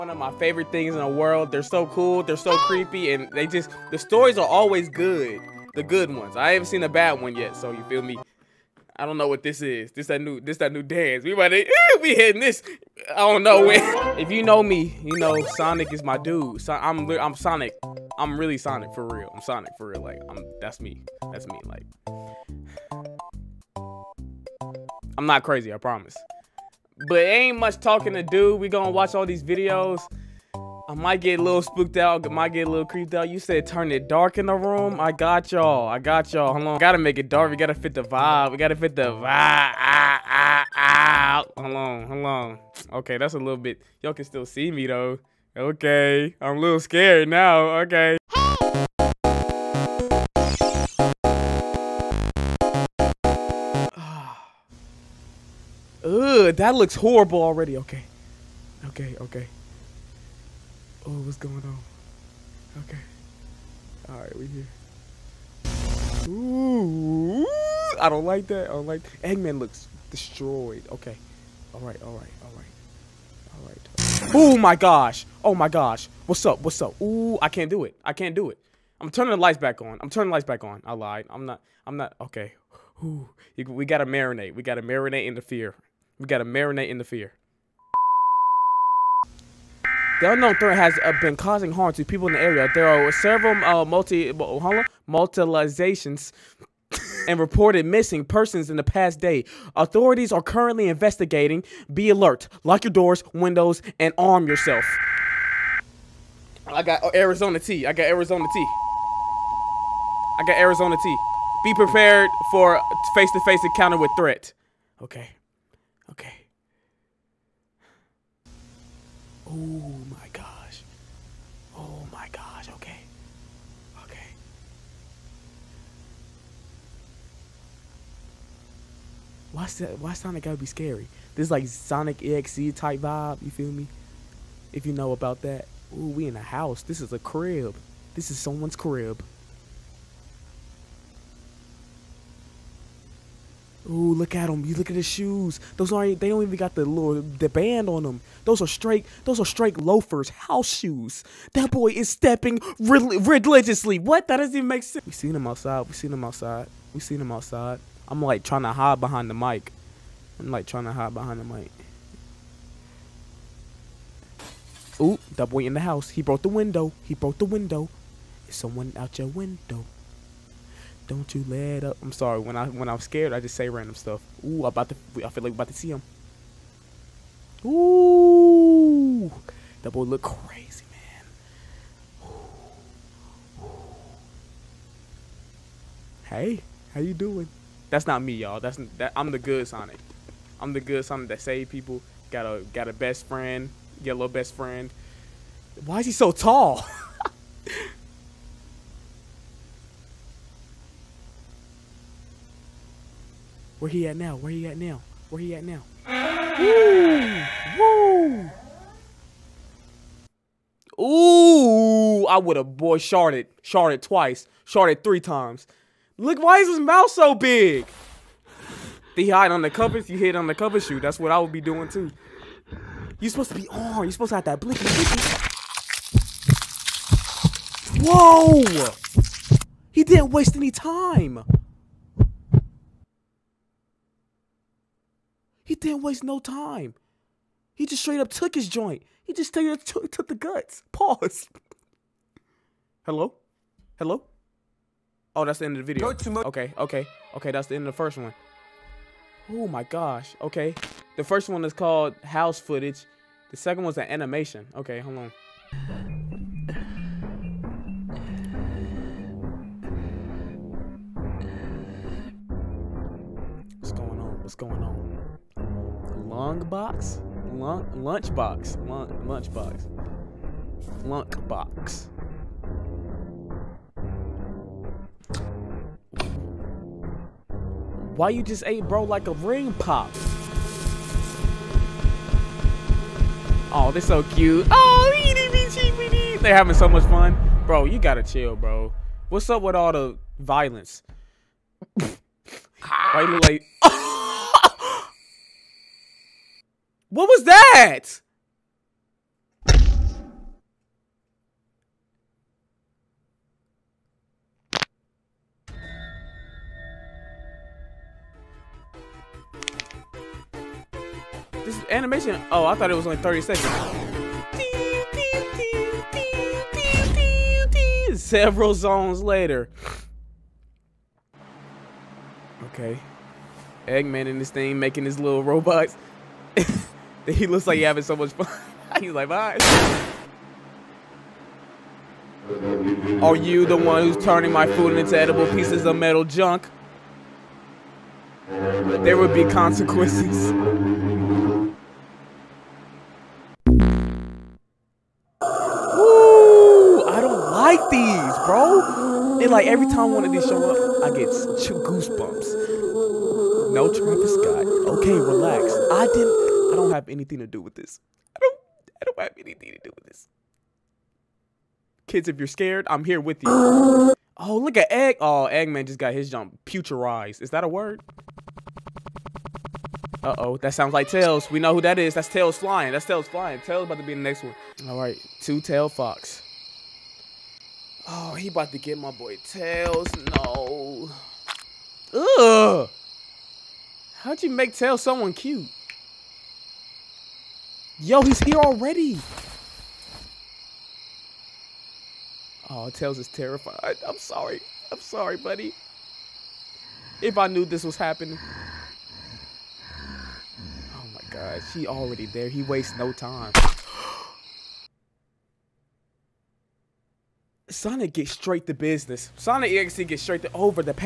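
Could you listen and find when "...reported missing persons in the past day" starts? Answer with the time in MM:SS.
01:37.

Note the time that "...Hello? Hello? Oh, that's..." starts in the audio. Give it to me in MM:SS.
04:03.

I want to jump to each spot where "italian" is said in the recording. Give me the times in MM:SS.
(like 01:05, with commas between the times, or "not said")
not said.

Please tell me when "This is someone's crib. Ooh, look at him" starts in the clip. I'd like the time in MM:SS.
02:18.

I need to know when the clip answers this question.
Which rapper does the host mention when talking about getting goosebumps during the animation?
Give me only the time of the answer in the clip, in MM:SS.
05:53.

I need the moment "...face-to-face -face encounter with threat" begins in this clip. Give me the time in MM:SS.
01:53.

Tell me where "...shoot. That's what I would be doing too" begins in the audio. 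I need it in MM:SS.
03:40.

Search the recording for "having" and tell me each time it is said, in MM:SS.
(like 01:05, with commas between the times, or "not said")
04:46, 05:27.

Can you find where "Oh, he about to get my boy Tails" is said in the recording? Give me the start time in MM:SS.
06:18.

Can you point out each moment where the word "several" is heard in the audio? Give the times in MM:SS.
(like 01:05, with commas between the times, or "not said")
01:33, 05:18.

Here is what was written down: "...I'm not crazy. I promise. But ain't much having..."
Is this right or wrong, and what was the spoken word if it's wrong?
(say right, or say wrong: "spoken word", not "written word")
wrong: "talking", not "having".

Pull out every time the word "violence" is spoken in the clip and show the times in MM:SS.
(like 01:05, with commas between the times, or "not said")
04:50.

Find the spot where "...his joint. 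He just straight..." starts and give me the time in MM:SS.
03:58.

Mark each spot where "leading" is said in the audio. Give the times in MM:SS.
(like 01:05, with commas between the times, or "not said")
not said.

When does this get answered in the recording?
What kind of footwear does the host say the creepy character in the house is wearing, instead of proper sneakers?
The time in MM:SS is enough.
02:29.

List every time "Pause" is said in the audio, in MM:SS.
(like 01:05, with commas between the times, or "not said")
04:00.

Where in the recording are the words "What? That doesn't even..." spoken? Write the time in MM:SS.
02:34.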